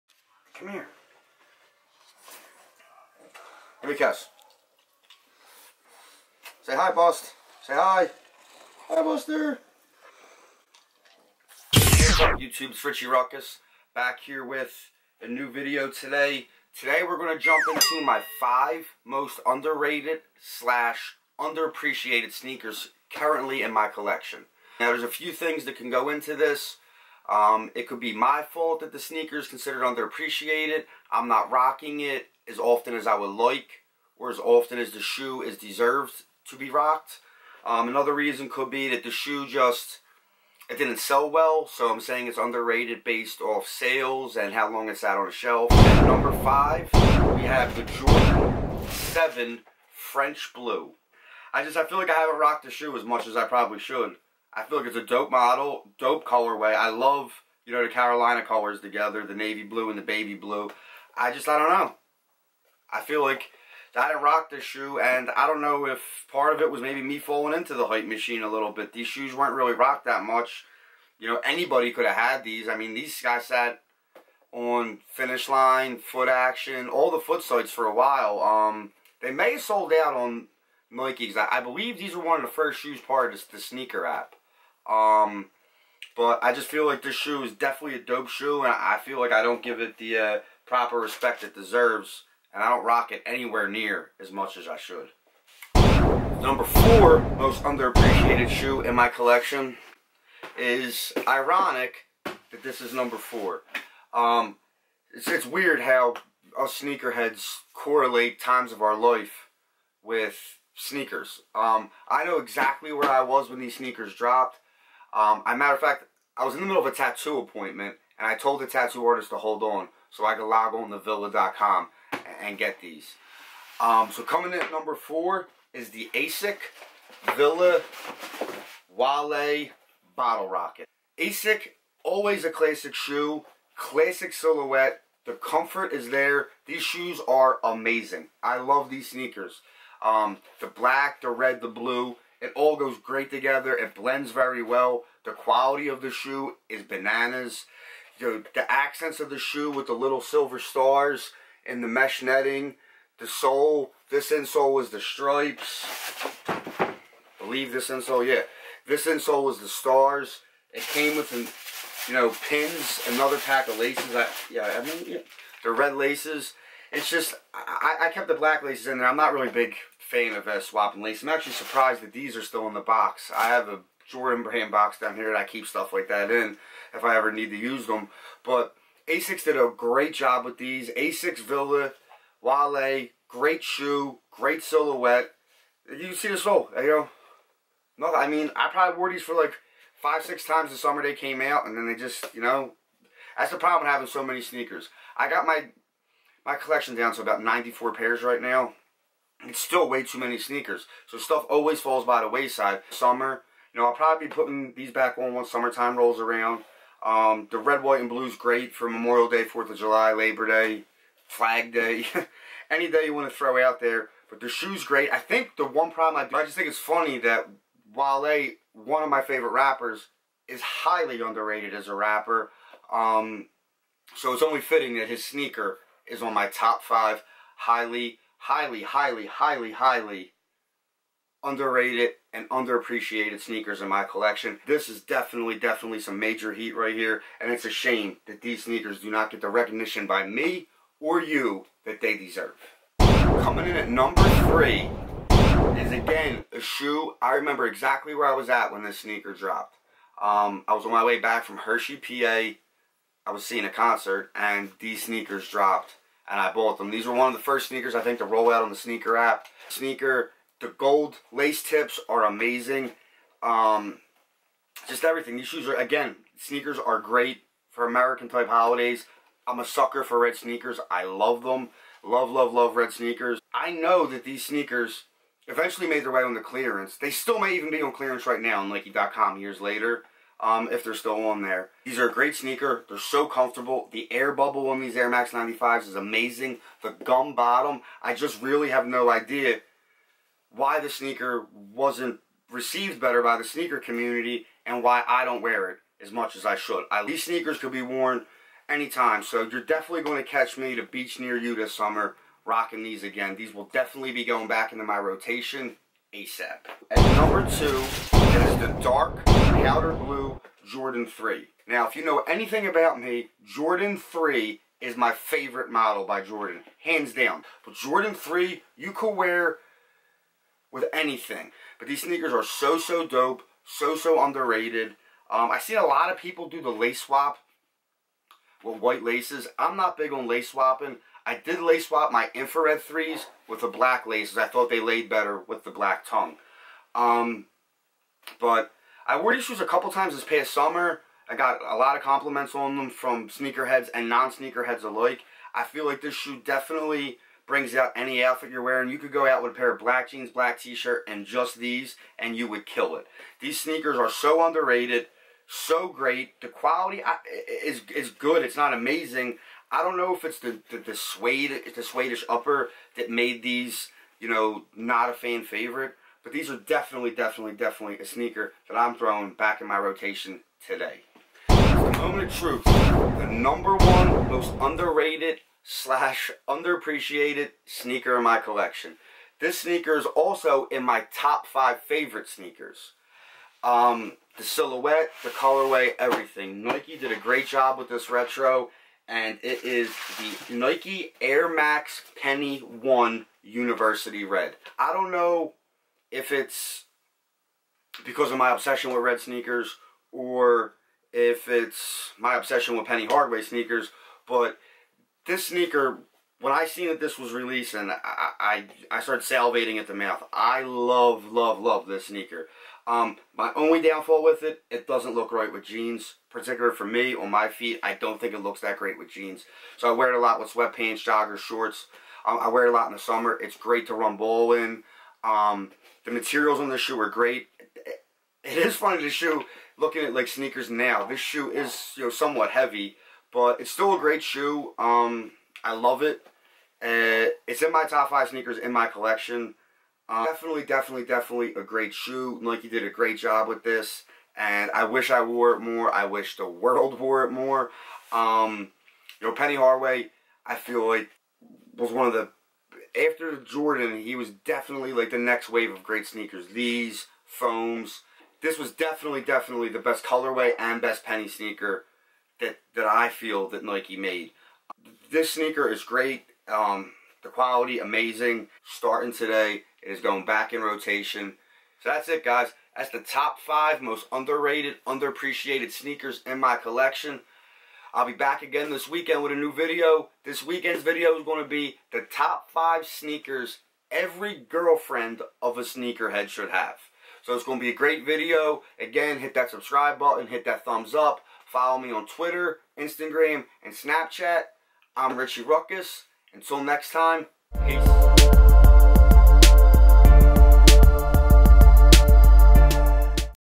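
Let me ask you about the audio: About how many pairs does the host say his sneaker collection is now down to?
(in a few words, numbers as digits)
94.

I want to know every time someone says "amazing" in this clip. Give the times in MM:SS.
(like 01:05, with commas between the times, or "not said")
02:17, 04:22, 04:45, 05:58, 07:47.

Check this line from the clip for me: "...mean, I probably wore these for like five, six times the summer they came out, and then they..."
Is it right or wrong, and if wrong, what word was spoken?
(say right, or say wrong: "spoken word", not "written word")
right.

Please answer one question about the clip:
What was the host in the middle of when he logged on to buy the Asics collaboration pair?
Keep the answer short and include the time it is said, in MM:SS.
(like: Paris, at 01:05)
A tattoo appointment, at 01:56.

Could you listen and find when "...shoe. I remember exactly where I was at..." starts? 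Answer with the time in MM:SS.
04:06.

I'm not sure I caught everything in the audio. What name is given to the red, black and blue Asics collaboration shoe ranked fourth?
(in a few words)
Bottle Rocket.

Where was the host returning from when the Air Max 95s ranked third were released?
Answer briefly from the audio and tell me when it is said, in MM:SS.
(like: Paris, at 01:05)
Hershey, PA, at 04:11.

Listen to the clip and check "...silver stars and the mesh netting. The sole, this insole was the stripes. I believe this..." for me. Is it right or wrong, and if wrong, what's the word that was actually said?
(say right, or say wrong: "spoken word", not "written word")
right.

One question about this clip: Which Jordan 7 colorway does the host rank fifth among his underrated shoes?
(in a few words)
French Blue.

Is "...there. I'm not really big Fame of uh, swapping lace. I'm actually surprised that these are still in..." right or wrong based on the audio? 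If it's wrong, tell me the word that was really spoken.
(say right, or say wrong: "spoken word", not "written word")
right.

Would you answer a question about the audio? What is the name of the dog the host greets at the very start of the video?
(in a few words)
Buster.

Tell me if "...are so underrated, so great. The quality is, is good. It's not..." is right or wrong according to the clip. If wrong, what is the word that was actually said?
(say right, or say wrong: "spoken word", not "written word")
right.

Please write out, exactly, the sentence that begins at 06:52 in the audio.
Um, my only downfall with it, it doesn't look right with jeans.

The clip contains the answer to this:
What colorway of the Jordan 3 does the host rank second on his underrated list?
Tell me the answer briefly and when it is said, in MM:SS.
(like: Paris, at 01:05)
Dark powder blue, at 05:08.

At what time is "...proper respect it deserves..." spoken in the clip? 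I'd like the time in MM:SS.
01:30.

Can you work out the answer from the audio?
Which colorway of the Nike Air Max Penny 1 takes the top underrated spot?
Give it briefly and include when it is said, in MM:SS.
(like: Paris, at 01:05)
University Red, at 06:33.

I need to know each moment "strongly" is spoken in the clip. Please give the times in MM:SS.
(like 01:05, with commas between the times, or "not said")
not said.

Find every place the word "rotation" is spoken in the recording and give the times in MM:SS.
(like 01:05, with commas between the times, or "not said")
05:04, 06:09, 07:50.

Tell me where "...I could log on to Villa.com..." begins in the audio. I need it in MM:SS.
02:00.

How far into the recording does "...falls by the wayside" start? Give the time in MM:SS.
03:21.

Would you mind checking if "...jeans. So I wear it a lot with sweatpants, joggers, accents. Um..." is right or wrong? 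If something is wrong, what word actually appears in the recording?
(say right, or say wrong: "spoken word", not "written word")
wrong: "shorts", not "accents".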